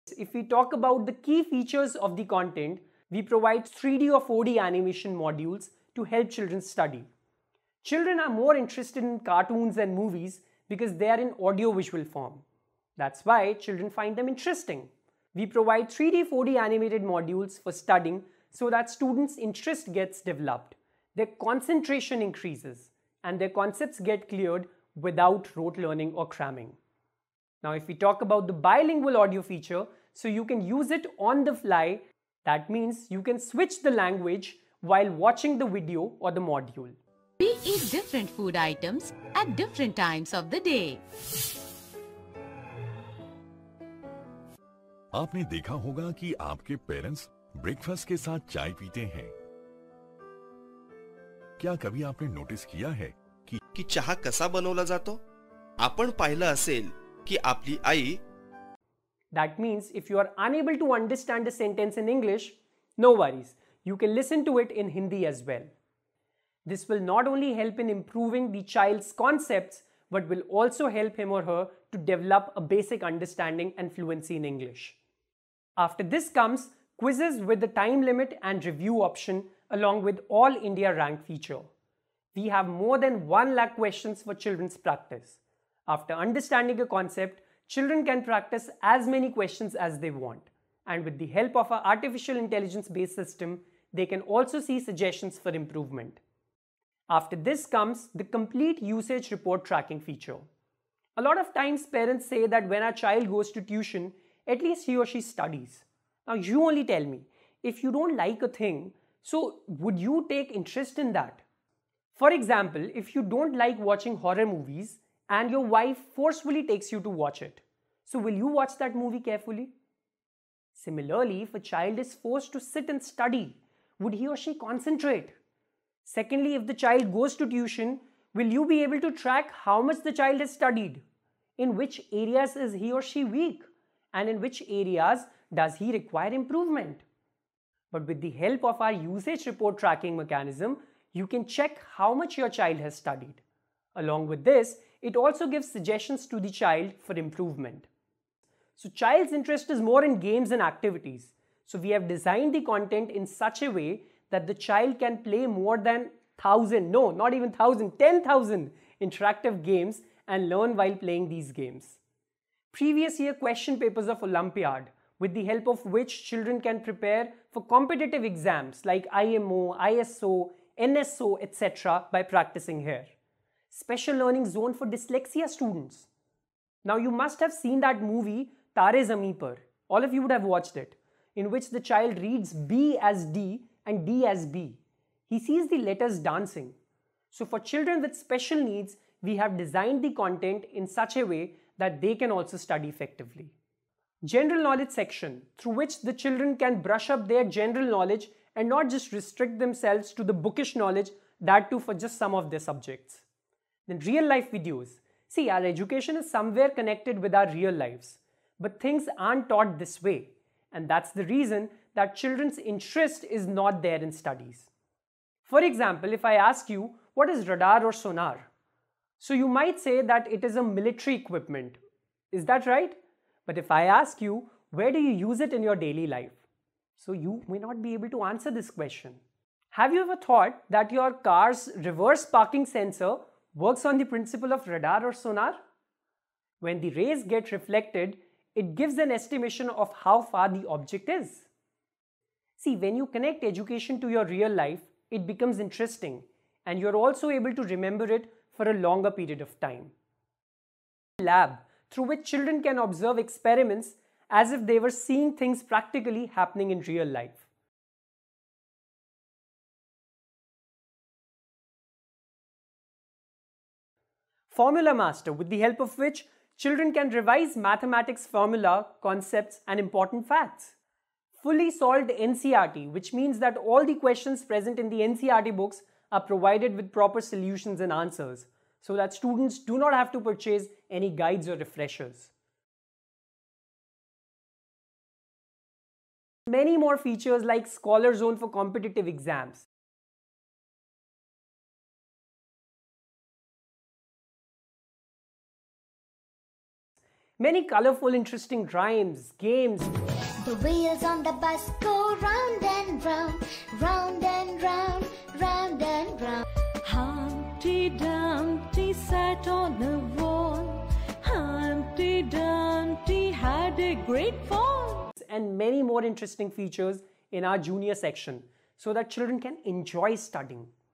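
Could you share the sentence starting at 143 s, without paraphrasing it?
Along with this, it also gives suggestions to the child for improvement.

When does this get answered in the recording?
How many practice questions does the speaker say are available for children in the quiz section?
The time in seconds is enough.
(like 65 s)
82 s.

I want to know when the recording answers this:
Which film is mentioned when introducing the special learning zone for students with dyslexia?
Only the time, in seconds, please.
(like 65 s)
178 s.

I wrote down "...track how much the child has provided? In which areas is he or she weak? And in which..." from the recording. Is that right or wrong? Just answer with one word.
wrong.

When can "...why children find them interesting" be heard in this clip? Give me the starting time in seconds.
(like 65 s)
13 s.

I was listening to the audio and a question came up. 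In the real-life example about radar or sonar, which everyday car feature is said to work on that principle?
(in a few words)
reverse parking sensor.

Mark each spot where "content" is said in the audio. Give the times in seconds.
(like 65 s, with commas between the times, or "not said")
2 s, 152 s, 190 s.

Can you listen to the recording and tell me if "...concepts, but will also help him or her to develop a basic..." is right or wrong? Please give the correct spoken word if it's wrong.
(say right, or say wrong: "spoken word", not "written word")
right.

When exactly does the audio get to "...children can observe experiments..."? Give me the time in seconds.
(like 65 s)
252 s.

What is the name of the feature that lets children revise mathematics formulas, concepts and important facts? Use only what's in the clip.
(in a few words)
Formula Master.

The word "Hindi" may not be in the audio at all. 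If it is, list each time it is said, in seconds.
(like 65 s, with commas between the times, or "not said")
64 s.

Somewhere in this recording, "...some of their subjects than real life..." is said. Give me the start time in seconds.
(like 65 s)
202 s.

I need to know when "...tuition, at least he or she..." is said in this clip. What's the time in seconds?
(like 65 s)
103 s.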